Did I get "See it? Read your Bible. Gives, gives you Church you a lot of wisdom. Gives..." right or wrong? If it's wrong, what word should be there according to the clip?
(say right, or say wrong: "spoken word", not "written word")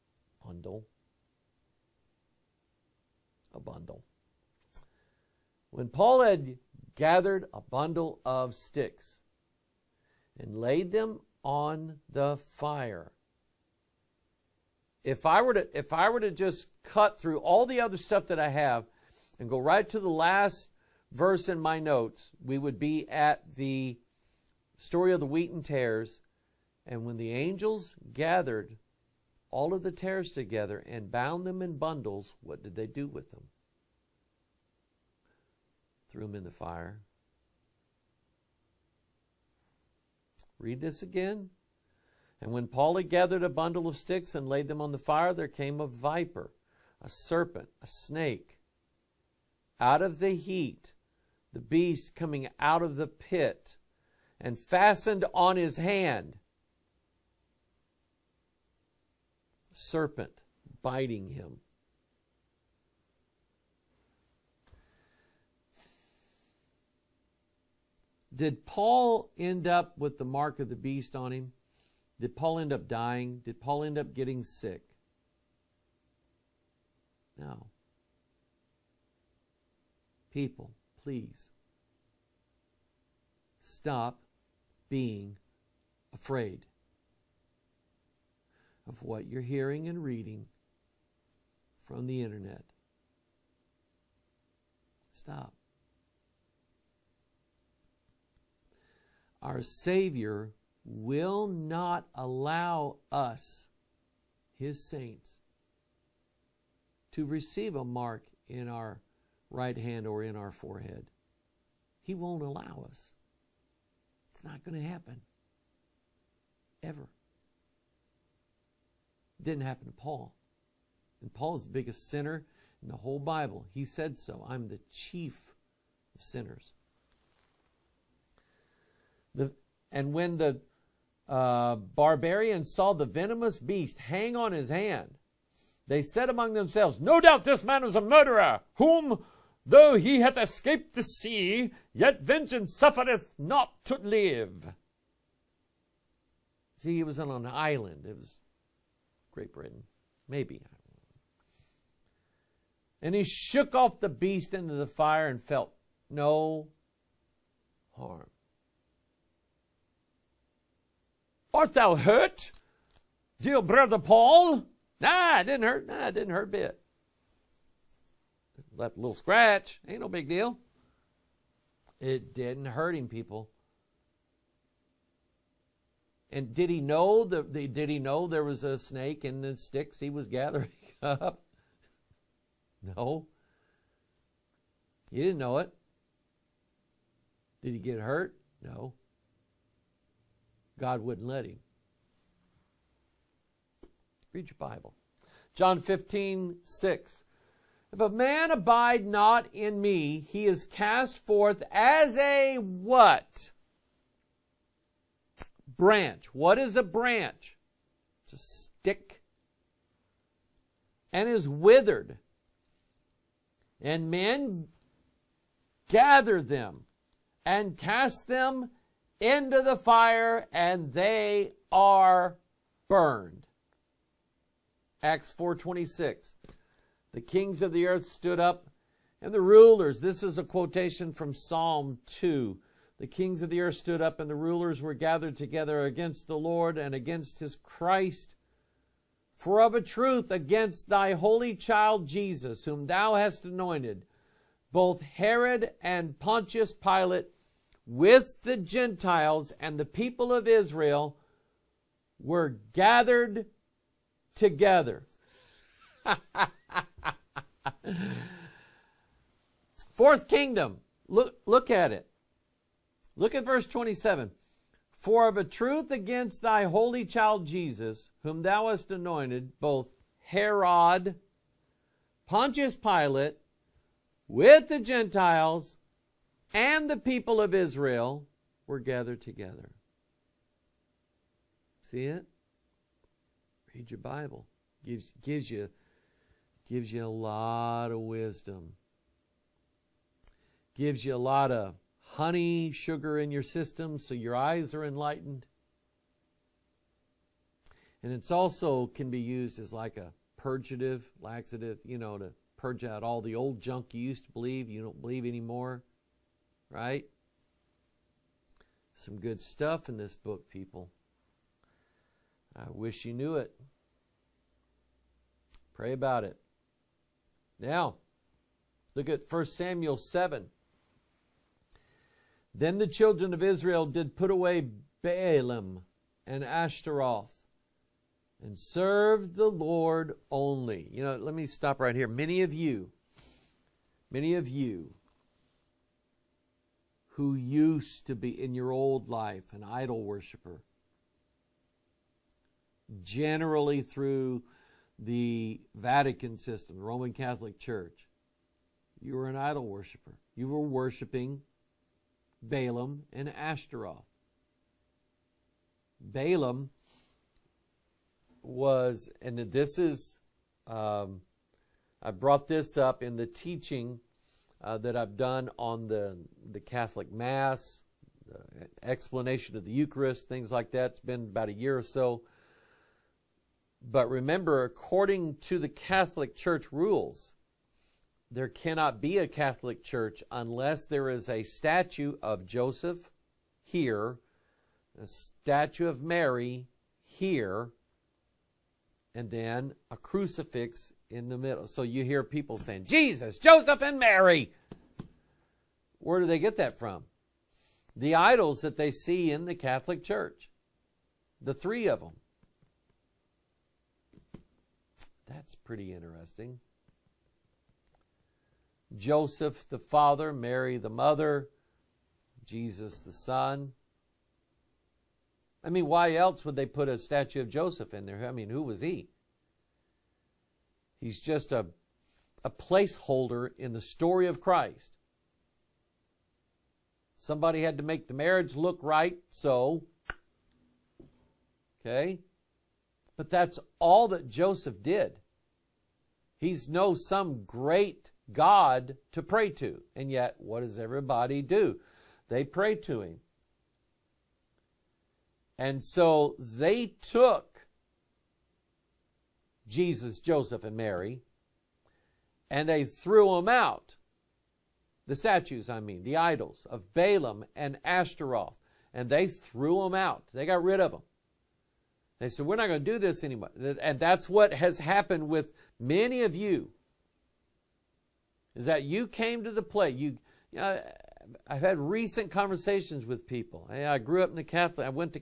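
wrong: "Gives", not "Church".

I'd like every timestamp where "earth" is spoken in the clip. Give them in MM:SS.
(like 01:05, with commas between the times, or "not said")
03:47, 03:53.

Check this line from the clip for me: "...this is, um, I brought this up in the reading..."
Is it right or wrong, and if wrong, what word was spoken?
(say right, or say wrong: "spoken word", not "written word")
wrong: "teaching", not "reading".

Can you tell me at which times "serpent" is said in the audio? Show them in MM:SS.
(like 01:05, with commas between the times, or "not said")
00:47, 00:59.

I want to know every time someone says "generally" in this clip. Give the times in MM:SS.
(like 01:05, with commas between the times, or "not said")
05:43.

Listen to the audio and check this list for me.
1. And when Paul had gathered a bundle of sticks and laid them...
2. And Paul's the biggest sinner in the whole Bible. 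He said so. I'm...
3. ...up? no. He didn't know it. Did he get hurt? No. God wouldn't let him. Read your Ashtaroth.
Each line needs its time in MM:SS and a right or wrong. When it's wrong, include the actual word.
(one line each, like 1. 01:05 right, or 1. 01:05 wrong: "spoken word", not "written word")
1. 00:42 right
2. 02:01 right
3. 03:01 wrong: "Bible", not "Ashtaroth".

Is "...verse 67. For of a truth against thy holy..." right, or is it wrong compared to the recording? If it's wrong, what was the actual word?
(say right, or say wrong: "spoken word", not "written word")
wrong: "27", not "67".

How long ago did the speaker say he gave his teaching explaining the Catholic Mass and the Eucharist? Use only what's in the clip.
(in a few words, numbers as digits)
About a year.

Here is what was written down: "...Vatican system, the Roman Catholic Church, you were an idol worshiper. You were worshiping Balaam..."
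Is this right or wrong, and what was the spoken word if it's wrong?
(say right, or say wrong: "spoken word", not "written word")
right.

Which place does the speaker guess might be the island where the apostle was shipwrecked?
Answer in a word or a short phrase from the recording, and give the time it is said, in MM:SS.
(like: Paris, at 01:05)
Great Britain, at 02:29.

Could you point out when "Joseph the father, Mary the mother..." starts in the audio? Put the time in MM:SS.
06:48.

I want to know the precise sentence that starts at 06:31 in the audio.
So you hear people saying, Jesus, Joseph, and Mary.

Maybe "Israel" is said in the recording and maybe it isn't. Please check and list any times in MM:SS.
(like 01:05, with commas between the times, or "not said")
04:10, 04:37, 05:23.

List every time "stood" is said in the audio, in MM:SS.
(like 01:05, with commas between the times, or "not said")
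03:48, 03:53.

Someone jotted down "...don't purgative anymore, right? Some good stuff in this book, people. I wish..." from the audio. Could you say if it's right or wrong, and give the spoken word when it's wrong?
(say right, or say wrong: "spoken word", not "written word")
wrong: "believe", not "purgative".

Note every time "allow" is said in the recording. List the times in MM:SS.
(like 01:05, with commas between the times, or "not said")
01:42, 01:52.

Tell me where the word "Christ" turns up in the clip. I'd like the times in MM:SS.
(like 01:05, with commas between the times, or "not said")
03:57, 07:04.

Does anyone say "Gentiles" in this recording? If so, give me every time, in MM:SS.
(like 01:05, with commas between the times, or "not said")
04:08, 04:34.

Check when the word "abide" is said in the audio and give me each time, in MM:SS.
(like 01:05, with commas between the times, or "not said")
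03:18.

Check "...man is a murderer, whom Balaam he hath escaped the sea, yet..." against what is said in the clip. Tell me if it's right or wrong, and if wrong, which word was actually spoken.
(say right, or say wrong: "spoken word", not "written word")
wrong: "Though", not "Balaam".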